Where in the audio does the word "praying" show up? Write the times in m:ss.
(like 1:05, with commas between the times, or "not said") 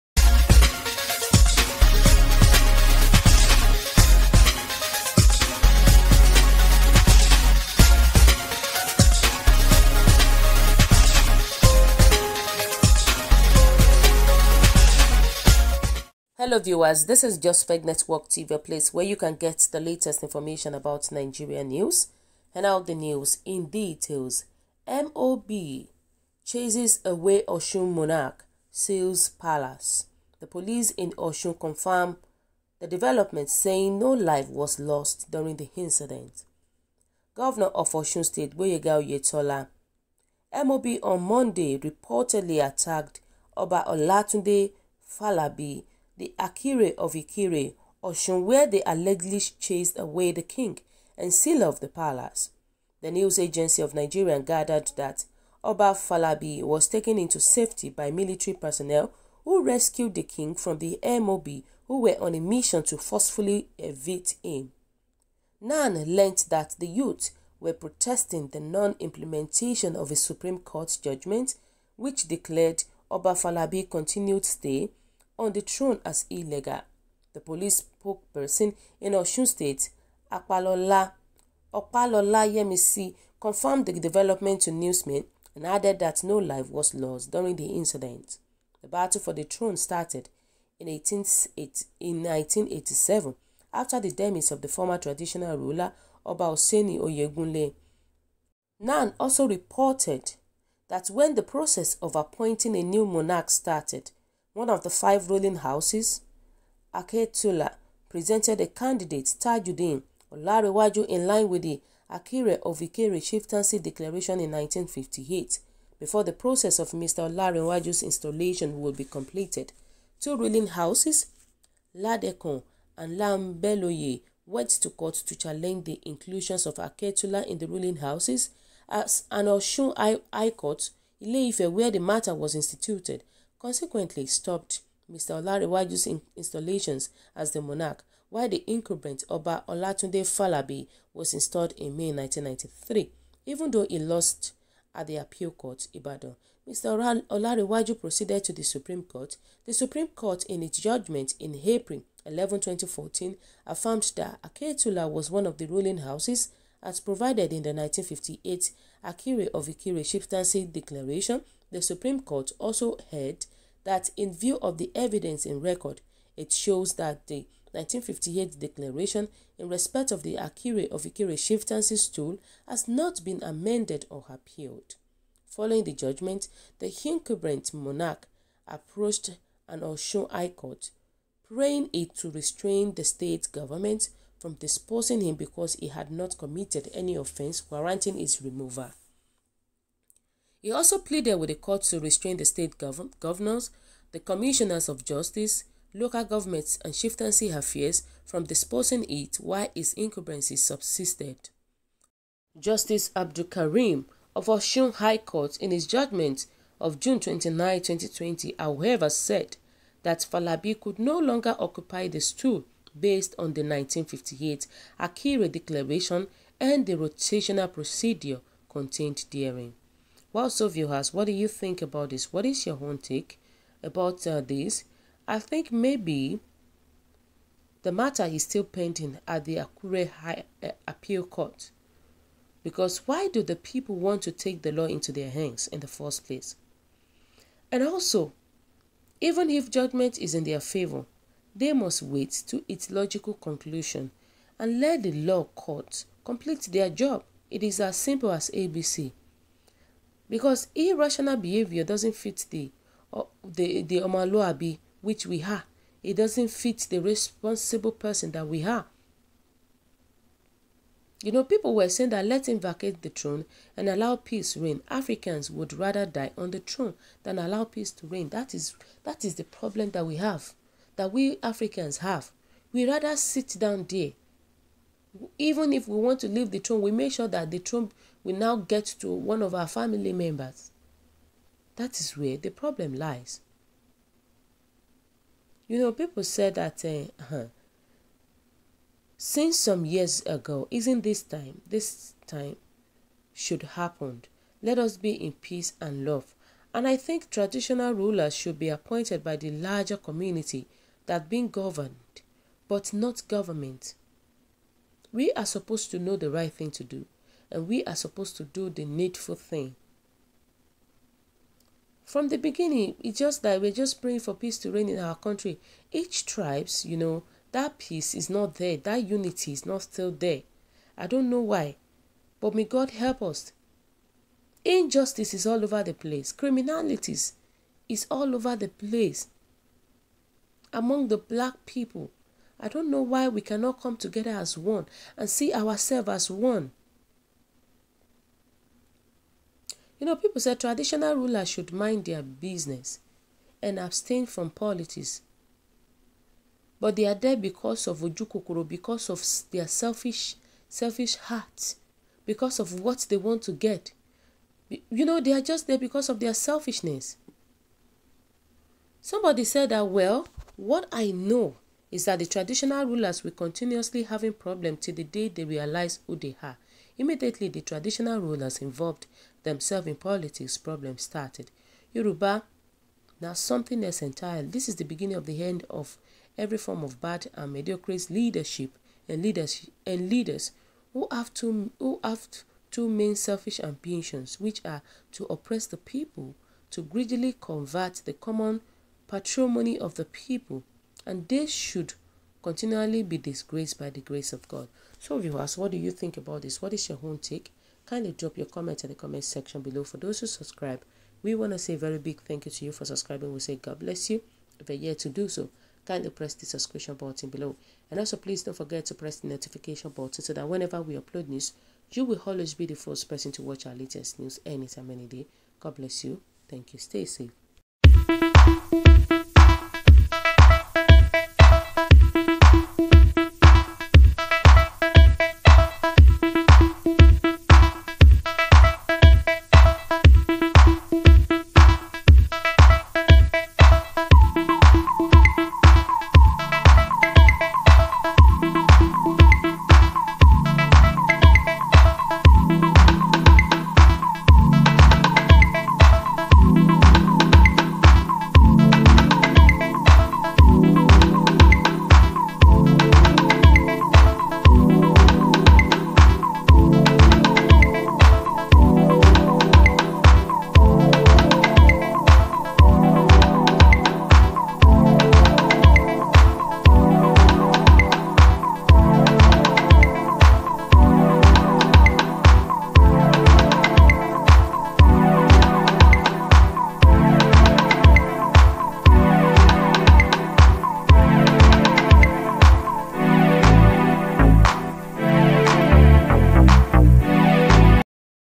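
3:01, 5:14.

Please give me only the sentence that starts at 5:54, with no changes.
You know, they are just there because of their selfishness.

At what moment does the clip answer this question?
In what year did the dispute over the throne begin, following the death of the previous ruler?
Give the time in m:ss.
1:32.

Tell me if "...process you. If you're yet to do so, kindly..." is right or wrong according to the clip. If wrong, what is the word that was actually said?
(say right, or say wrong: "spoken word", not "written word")
wrong: "bless", not "process".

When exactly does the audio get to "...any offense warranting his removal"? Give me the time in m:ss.
3:06.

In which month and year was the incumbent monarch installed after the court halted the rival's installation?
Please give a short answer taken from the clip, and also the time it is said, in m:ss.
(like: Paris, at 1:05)
May 1993, at 2:21.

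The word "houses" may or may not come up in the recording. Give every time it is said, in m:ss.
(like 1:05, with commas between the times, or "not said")
1:45, 2:00, 2:07, 2:35.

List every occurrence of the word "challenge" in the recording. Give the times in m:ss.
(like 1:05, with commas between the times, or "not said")
2:05.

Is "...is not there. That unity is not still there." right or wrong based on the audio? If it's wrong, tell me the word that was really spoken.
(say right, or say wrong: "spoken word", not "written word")
right.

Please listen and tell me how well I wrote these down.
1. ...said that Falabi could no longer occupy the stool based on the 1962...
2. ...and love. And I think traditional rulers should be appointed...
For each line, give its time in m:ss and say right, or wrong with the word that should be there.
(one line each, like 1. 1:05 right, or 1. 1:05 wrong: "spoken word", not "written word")
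1. 3:29 wrong: "1958", not "1962"
2. 4:55 right.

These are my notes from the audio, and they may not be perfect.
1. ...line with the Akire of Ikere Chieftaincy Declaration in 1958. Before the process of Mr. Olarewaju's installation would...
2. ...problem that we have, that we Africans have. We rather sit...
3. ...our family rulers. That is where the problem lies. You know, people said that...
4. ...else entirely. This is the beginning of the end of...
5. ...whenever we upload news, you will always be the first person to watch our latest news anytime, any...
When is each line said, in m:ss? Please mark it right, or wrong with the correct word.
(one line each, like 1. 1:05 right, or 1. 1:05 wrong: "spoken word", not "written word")
1. 1:51 right
2. 4:29 right
3. 4:39 wrong: "members", not "rulers"
4. 6:13 right
5. 6:50 right.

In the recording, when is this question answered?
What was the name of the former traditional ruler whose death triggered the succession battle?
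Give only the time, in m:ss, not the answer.
1:36.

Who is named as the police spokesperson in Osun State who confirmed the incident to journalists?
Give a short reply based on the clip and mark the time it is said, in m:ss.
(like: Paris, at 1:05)
Opalola Yemisi, at 1:21.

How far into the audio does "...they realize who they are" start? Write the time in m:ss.
6:05.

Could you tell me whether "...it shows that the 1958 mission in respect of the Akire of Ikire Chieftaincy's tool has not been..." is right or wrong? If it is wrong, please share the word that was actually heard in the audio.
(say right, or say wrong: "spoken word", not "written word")
wrong: "declaration", not "mission".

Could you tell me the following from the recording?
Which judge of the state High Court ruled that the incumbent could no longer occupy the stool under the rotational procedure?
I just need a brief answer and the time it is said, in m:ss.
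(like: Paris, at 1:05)
Justice Abdul Karim, at 3:22.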